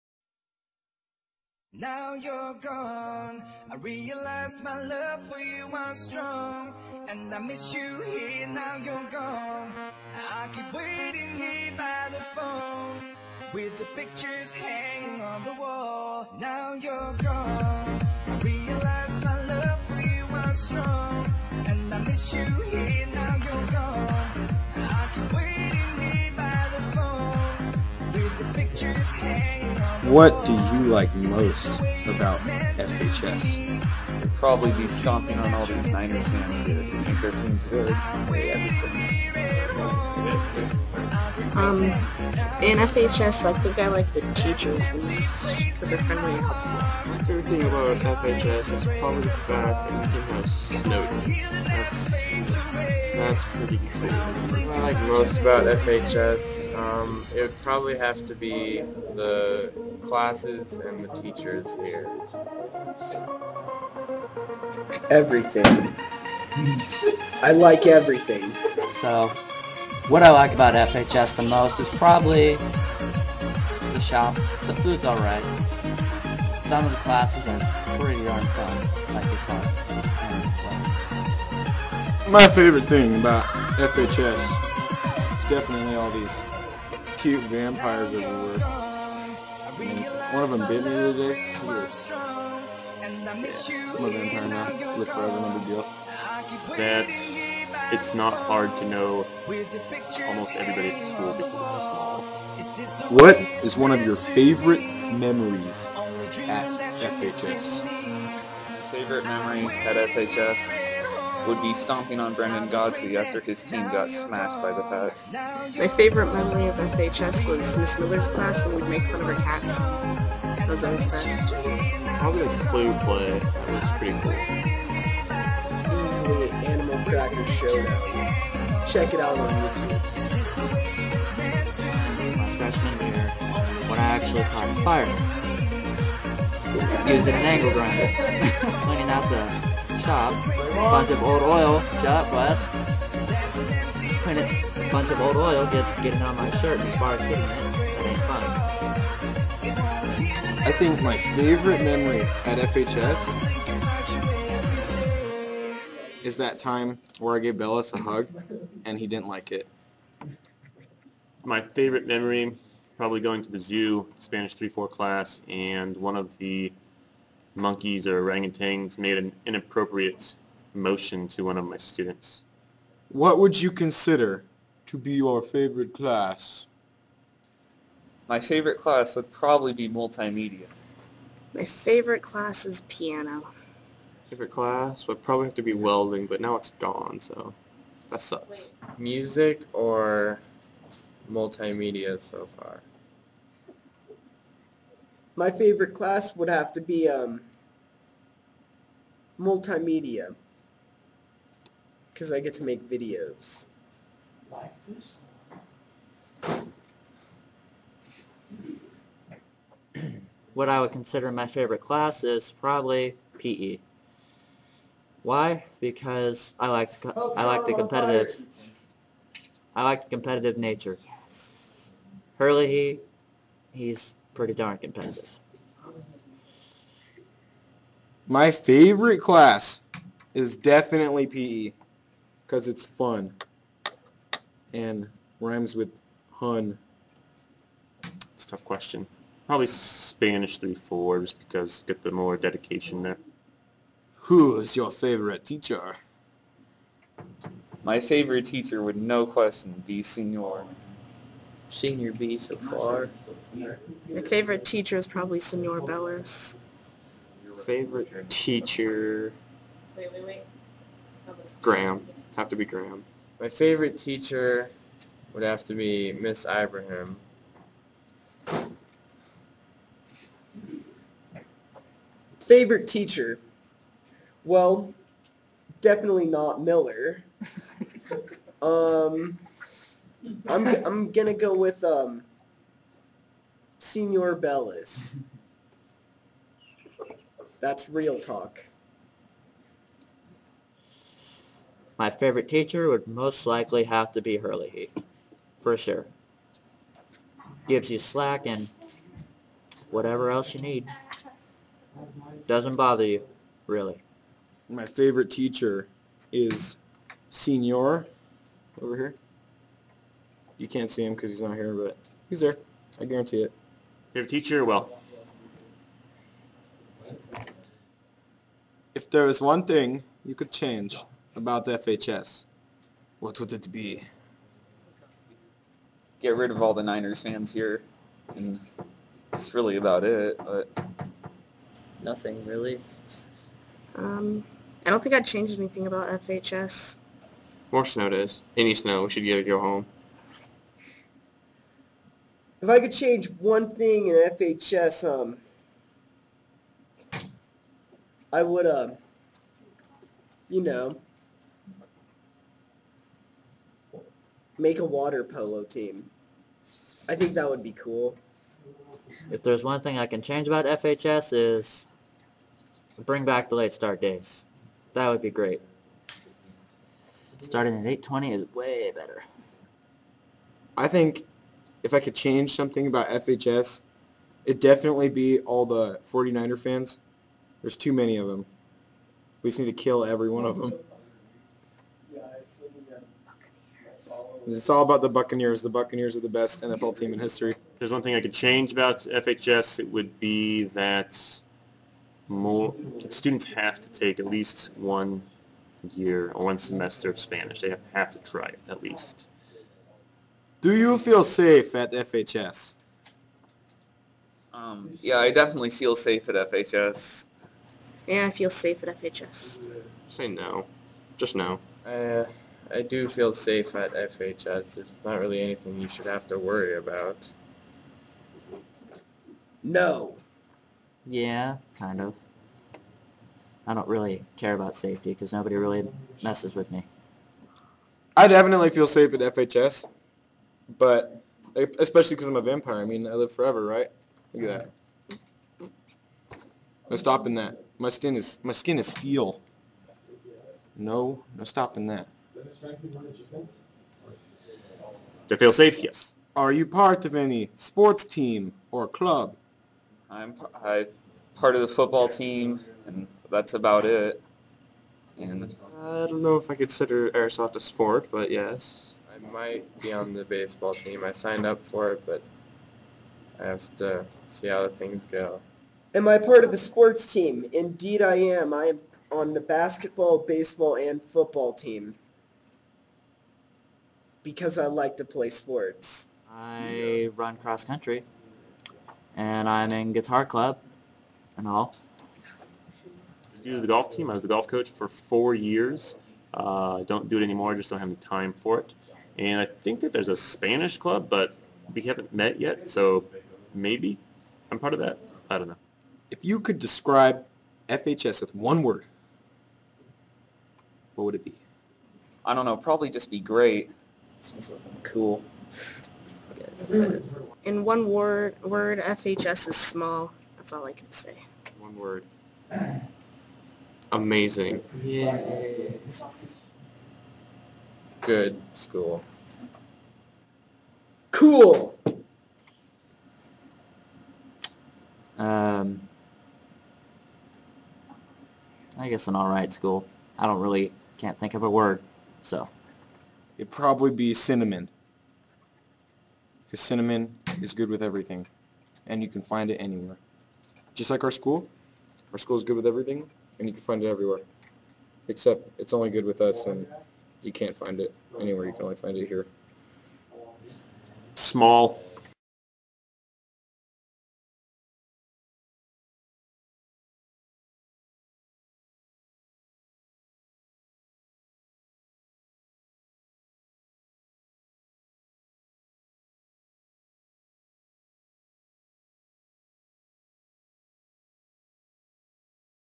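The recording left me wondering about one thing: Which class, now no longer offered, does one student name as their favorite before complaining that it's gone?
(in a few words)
welding.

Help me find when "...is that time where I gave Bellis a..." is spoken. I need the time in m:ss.
2:36.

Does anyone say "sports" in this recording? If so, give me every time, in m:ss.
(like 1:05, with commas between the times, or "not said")
7:27, 7:37, 7:46, 7:55.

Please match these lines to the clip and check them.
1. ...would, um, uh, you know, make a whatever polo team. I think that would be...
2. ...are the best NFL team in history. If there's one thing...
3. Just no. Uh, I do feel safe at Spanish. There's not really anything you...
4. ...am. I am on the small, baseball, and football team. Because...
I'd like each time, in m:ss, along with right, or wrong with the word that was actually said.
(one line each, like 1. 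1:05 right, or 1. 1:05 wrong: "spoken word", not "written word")
1. 5:48 wrong: "water", not "whatever"
2. 6:26 right
3. 6:51 wrong: "FHS", not "Spanish"
4. 7:48 wrong: "basketball", not "small".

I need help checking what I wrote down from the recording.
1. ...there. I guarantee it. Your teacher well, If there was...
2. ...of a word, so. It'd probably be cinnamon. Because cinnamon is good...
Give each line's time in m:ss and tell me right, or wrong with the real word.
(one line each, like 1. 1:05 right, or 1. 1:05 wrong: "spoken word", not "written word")
1. 5:12 right
2. 8:51 right.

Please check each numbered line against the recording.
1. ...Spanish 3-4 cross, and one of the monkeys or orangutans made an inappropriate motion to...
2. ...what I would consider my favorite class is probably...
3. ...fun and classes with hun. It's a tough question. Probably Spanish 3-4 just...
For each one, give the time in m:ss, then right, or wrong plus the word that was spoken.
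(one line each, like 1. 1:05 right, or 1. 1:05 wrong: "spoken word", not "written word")
1. 2:44 wrong: "class", not "cross"
2. 3:30 right
3. 3:52 wrong: "rhymes", not "classes".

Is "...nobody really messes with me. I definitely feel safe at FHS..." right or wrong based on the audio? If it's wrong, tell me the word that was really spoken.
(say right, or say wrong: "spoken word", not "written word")
right.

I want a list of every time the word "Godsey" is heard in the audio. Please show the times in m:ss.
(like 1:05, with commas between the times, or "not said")
1:52.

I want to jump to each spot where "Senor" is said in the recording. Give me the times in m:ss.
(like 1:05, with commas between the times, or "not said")
4:10, 4:15, 4:43, 5:07.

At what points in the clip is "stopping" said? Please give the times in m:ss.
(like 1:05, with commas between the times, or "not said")
7:16, 7:21.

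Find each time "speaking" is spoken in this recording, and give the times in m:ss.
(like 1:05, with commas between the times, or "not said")
not said.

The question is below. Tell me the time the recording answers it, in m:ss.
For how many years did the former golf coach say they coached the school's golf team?
8:04.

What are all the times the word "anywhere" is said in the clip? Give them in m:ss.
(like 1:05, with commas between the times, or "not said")
8:59, 9:08.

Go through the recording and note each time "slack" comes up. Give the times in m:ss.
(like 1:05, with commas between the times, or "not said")
4:57.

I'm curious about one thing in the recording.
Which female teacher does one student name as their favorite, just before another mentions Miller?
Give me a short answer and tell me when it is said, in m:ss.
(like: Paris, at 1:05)
Miss Ibrahim, at 4:26.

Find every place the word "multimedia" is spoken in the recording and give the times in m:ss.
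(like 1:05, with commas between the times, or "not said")
2:59, 3:11, 3:19.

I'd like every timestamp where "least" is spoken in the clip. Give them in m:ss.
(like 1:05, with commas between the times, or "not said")
6:34, 6:38.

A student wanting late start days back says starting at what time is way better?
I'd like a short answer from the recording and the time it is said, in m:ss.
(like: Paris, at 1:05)
8:20, at 6:07.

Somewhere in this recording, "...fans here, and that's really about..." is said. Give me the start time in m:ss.
5:27.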